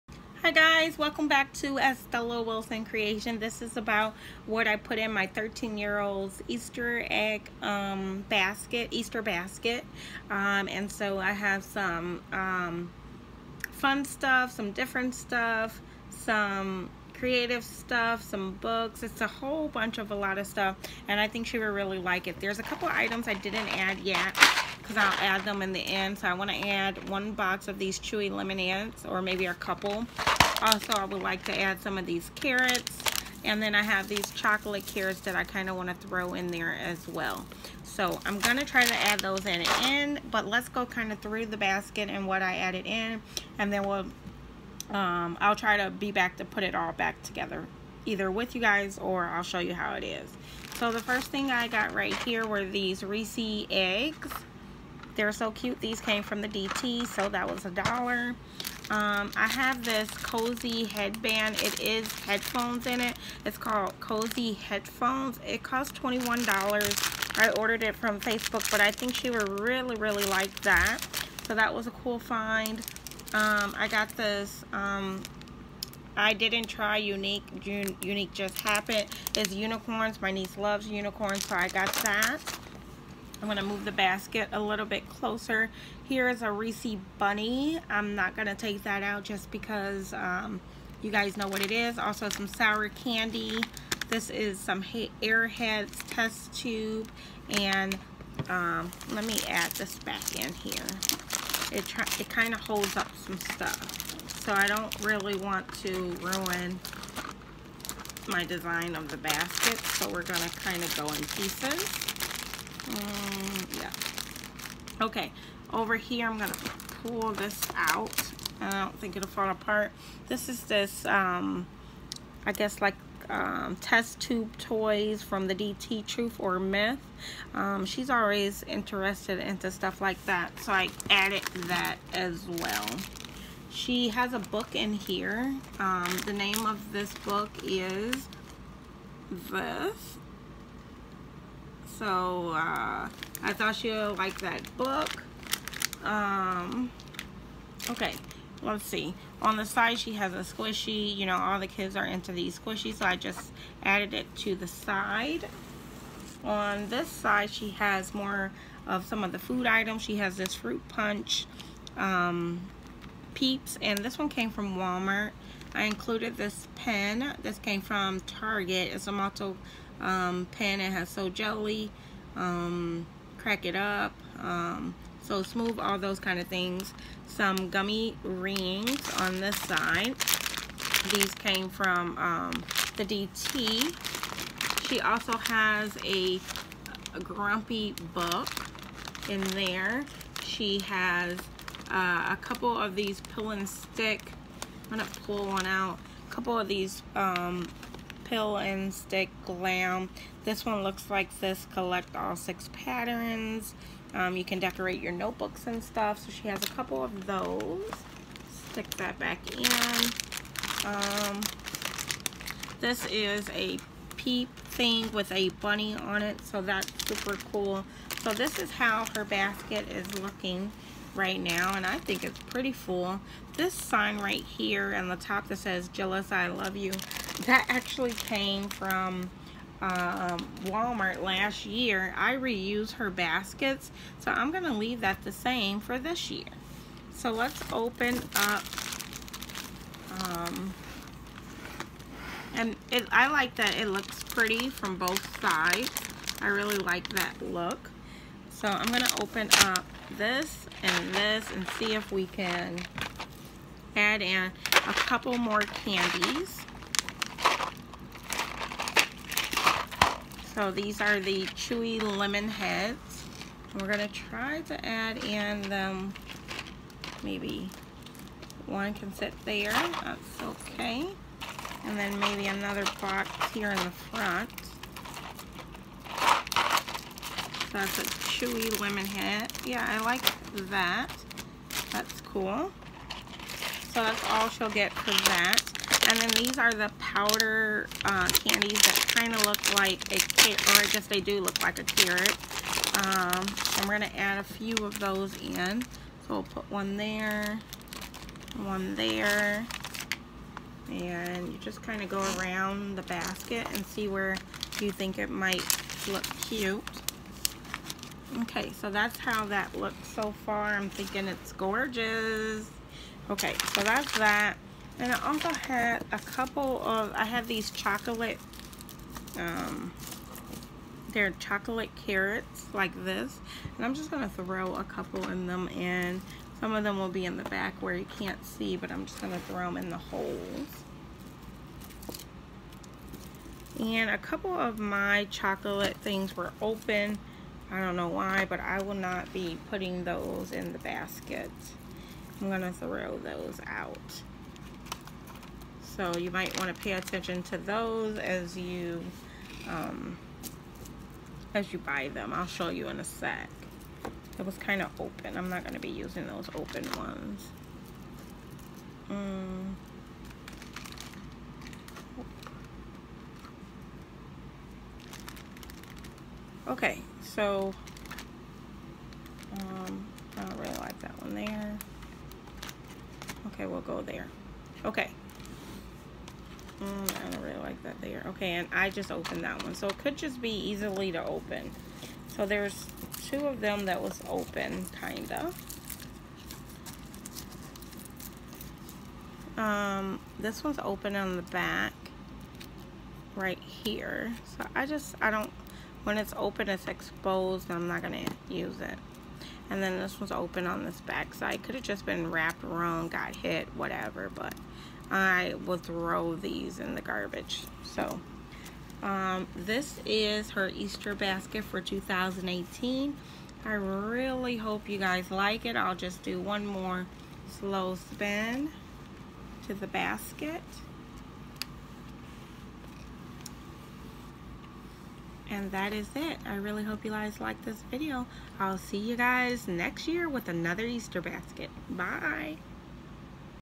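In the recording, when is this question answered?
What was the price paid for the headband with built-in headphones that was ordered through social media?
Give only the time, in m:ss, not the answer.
1:06.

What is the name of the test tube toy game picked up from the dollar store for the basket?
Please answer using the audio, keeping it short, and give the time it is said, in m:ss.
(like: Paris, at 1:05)
Truth or Myth, at 2:06.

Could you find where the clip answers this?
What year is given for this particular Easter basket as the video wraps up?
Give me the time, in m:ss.
6:51.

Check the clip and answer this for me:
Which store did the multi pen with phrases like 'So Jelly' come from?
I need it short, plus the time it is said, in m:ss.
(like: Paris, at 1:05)
Target, at 2:48.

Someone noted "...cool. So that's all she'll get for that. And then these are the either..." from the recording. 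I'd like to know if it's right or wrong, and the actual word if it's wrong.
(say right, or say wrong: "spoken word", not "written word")
wrong: "powder", not "either".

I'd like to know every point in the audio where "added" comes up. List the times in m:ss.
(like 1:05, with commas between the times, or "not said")
0:42, 2:11, 2:33.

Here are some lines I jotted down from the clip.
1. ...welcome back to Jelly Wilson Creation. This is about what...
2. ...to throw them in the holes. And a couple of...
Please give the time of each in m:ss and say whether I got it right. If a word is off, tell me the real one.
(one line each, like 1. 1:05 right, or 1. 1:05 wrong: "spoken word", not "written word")
1. 0:00 wrong: "Estella", not "Jelly"
2. 5:29 right.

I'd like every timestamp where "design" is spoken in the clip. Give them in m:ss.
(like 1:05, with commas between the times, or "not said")
1:48.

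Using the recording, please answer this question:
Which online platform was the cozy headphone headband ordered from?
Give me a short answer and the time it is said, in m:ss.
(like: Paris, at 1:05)
Facebook, at 1:08.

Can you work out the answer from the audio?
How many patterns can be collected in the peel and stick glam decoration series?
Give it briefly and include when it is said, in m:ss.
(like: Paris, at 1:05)
6, at 3:22.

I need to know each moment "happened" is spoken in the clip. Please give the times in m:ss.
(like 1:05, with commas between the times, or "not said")
1:18.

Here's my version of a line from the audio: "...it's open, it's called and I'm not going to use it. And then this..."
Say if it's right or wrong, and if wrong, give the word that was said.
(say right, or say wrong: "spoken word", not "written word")
wrong: "exposed", not "called".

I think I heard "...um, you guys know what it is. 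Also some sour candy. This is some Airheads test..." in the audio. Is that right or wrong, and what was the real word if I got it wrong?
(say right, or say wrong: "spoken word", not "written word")
right.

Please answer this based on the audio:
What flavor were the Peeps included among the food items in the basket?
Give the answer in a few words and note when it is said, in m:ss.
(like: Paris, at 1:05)
Fruit punch, at 2:40.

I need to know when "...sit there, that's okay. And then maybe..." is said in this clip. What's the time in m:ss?
4:29.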